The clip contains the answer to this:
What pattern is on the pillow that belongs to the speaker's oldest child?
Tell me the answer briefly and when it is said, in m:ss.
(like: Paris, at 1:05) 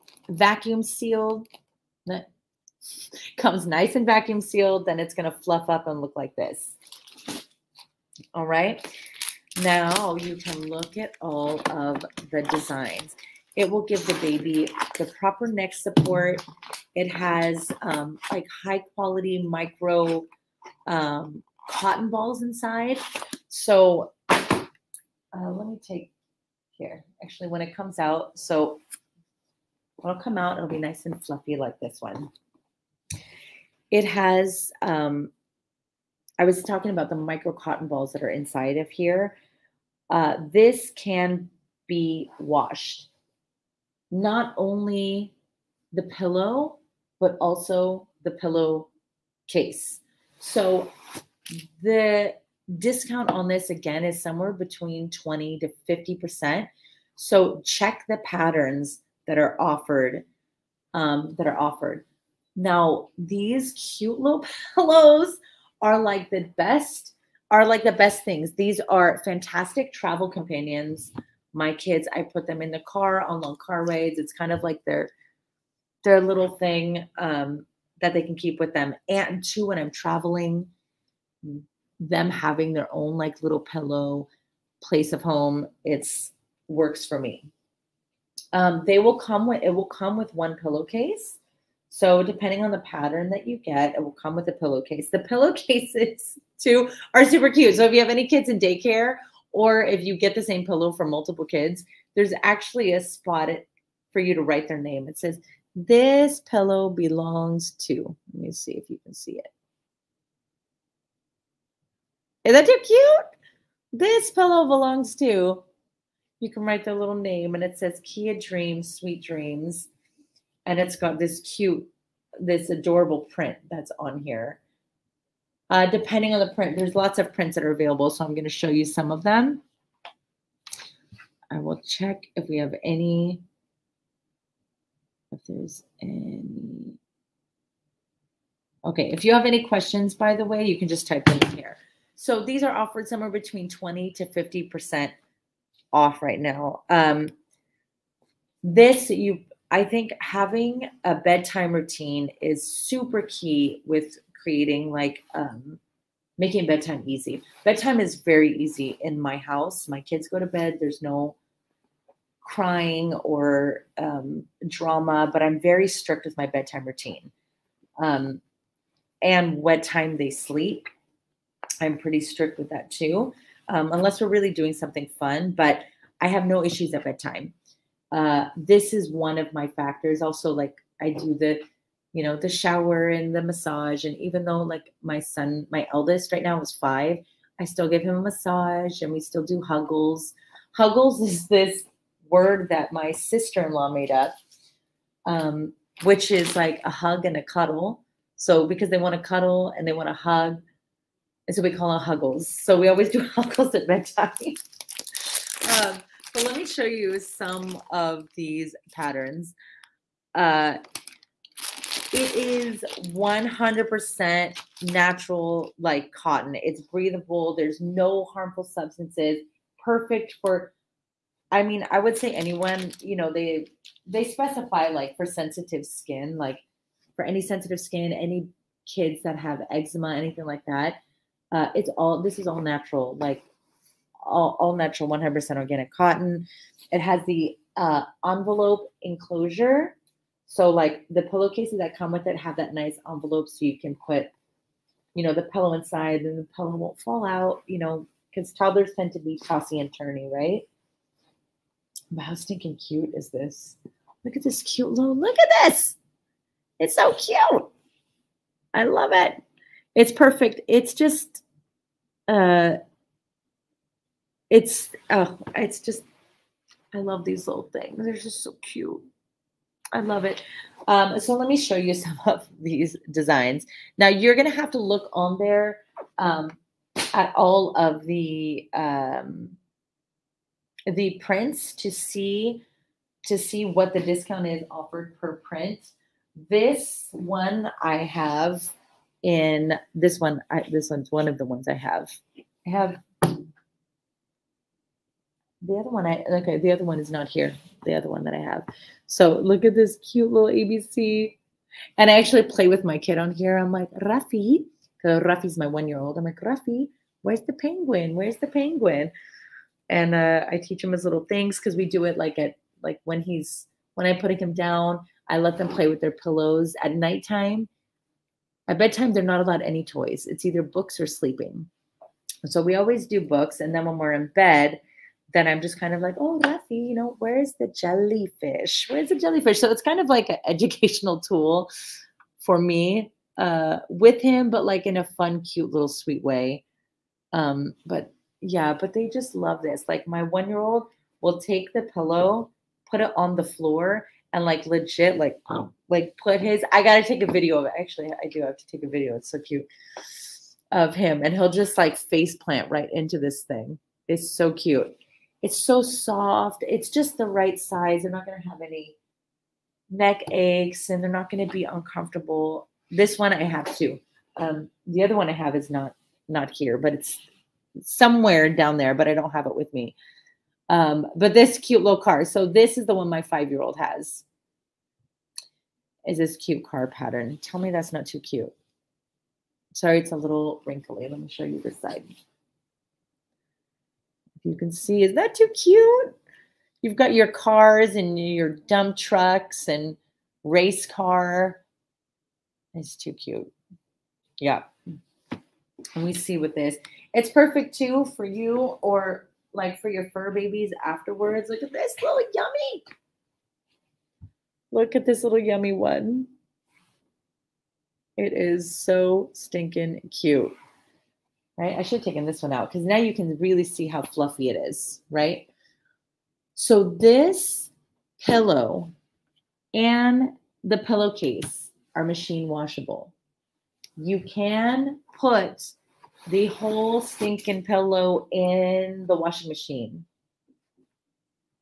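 car pattern, at 6:16.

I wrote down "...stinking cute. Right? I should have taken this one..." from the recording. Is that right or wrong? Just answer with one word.
right.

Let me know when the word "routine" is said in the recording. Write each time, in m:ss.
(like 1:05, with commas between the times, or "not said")
2:31, 2:46.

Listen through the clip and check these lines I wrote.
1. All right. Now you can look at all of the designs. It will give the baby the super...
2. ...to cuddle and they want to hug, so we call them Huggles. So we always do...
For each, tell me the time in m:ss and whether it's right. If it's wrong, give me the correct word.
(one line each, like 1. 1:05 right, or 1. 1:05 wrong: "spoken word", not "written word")
1. 0:08 wrong: "proper", not "super"
2. 3:19 right.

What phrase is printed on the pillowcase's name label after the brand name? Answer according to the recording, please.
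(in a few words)
Sweet Dreams.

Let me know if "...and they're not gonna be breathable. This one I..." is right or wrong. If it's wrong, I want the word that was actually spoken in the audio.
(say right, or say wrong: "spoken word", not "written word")
wrong: "uncomfortable", not "breathable".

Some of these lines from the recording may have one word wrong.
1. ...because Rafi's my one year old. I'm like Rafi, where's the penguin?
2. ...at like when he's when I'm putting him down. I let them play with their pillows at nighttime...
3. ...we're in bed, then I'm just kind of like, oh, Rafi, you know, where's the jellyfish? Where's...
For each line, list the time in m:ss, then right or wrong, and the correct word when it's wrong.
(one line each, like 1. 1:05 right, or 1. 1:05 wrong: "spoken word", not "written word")
1. 5:04 right
2. 5:12 right
3. 5:23 right.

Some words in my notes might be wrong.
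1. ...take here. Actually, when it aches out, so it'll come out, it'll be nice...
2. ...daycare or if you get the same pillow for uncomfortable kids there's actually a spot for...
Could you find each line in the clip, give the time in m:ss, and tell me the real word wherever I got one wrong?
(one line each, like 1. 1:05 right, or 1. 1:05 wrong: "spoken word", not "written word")
1. 0:25 wrong: "comes", not "aches"
2. 1:38 wrong: "multiple", not "uncomfortable".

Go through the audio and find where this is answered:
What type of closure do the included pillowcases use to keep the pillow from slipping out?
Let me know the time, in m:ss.
3:58.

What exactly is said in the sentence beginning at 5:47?
Actually, I do have to take a video.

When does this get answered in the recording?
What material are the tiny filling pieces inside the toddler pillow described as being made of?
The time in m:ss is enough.
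0:19.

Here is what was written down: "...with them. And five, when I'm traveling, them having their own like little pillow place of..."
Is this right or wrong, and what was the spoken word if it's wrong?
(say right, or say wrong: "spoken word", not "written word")
wrong: "two", not "five".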